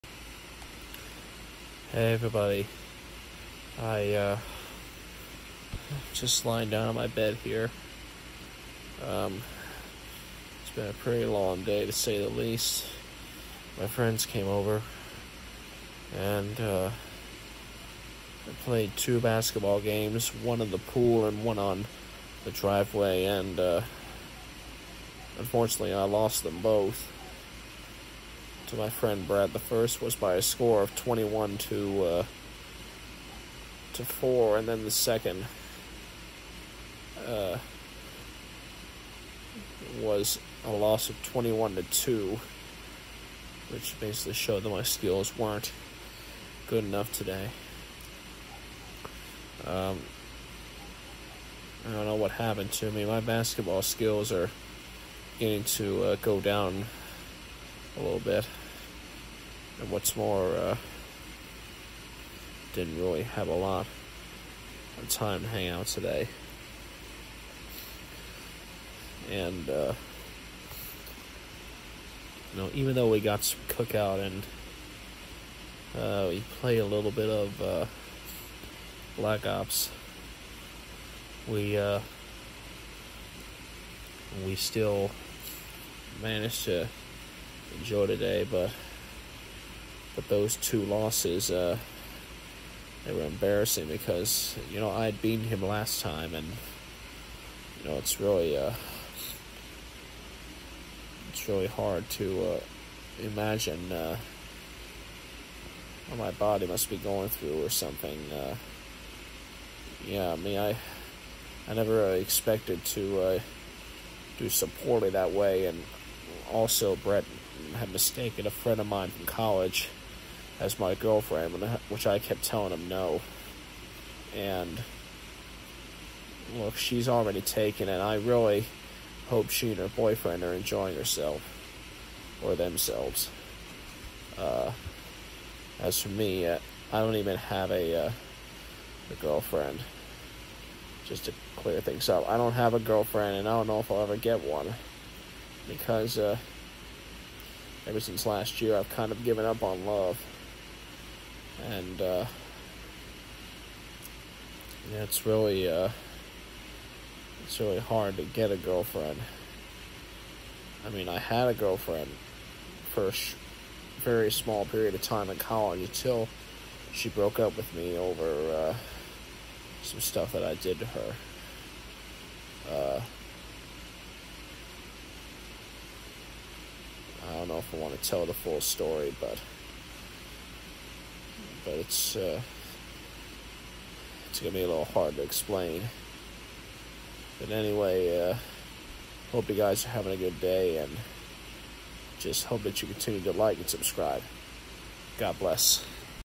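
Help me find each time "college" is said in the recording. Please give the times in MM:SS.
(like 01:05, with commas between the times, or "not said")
01:59, 02:45.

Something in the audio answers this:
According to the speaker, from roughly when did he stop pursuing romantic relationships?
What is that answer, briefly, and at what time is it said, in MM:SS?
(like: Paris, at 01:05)
last year, at 02:28.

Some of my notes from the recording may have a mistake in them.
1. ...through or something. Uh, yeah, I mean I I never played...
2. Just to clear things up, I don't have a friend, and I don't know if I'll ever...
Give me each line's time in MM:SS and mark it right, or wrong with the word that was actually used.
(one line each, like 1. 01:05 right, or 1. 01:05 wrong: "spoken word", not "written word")
1. 01:47 wrong: "expected", not "played"
2. 02:21 wrong: "girlfriend", not "friend".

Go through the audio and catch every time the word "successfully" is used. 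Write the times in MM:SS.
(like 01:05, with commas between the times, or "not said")
not said.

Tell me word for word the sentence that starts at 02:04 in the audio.
And look, she's already taken, and I really hope she and her boyfriend are enjoying herself or themselves.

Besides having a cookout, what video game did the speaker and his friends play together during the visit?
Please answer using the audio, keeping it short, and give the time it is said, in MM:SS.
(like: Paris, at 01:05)
Black Ops, at 01:19.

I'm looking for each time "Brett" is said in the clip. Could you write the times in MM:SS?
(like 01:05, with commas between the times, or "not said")
01:56.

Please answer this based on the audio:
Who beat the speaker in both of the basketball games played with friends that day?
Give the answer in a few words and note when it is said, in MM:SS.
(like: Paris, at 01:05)
Brad, at 00:29.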